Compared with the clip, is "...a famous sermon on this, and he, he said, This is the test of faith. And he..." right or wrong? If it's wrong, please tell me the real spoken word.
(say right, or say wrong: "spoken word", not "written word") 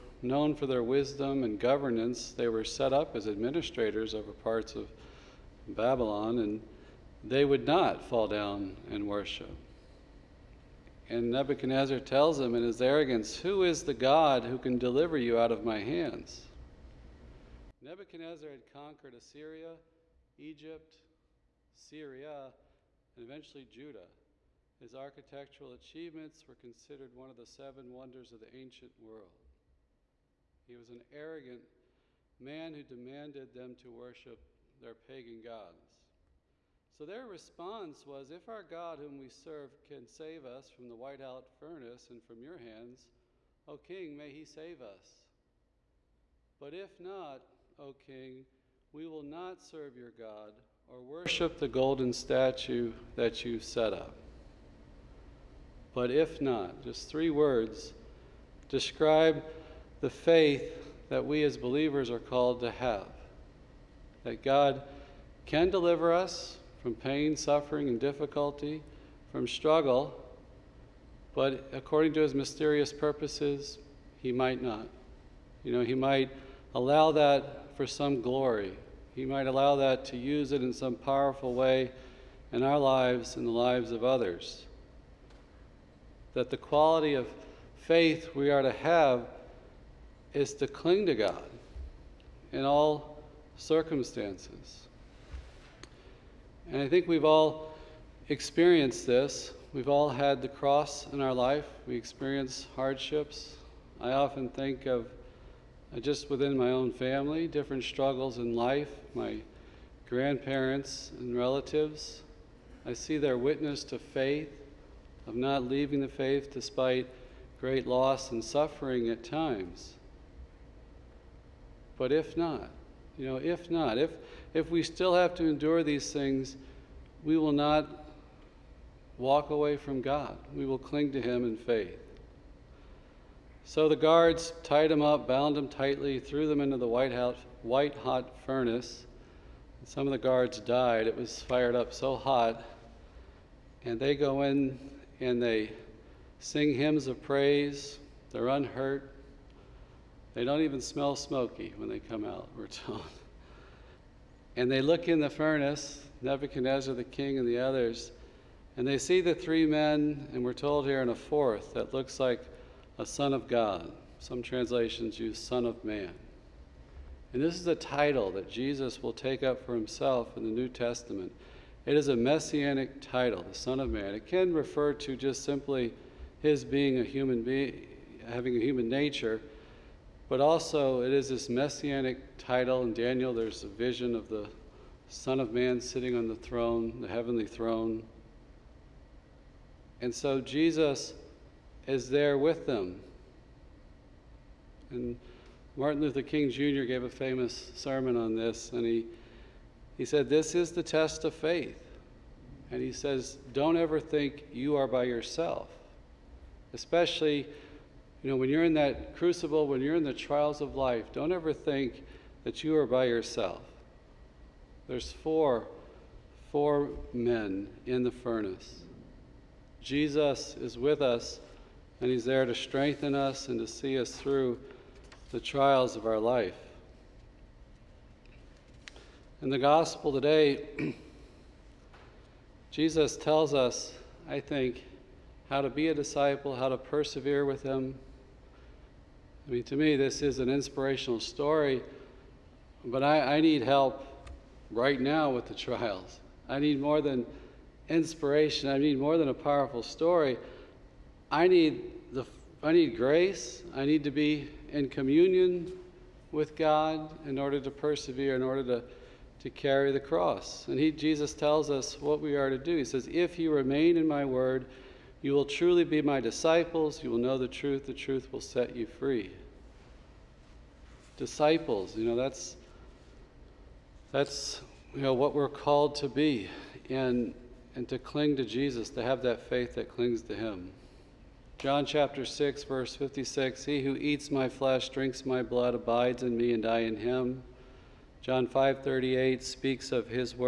right.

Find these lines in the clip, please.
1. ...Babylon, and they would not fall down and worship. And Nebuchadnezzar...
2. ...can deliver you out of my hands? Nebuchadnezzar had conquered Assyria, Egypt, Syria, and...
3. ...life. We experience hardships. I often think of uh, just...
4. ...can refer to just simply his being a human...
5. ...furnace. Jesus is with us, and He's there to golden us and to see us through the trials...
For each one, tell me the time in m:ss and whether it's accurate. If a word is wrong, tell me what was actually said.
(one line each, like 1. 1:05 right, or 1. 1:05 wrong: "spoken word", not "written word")
1. 0:05 right
2. 0:14 right
3. 1:41 right
4. 2:54 right
5. 3:38 wrong: "strengthen", not "golden".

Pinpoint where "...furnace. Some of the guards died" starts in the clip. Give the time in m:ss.
2:18.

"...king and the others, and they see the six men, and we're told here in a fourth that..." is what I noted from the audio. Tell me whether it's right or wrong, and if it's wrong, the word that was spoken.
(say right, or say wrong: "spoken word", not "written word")
wrong: "three", not "six".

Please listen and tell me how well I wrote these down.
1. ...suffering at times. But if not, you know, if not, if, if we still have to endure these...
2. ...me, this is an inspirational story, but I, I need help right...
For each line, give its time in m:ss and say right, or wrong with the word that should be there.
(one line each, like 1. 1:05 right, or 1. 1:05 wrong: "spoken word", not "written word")
1. 1:58 right
2. 3:59 right.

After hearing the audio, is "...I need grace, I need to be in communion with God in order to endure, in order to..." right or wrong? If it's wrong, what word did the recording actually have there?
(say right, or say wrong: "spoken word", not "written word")
wrong: "persevere", not "endure".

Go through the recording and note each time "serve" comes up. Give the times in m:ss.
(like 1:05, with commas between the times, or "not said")
0:39, 0:49.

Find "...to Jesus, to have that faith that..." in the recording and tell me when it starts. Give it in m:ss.
4:38.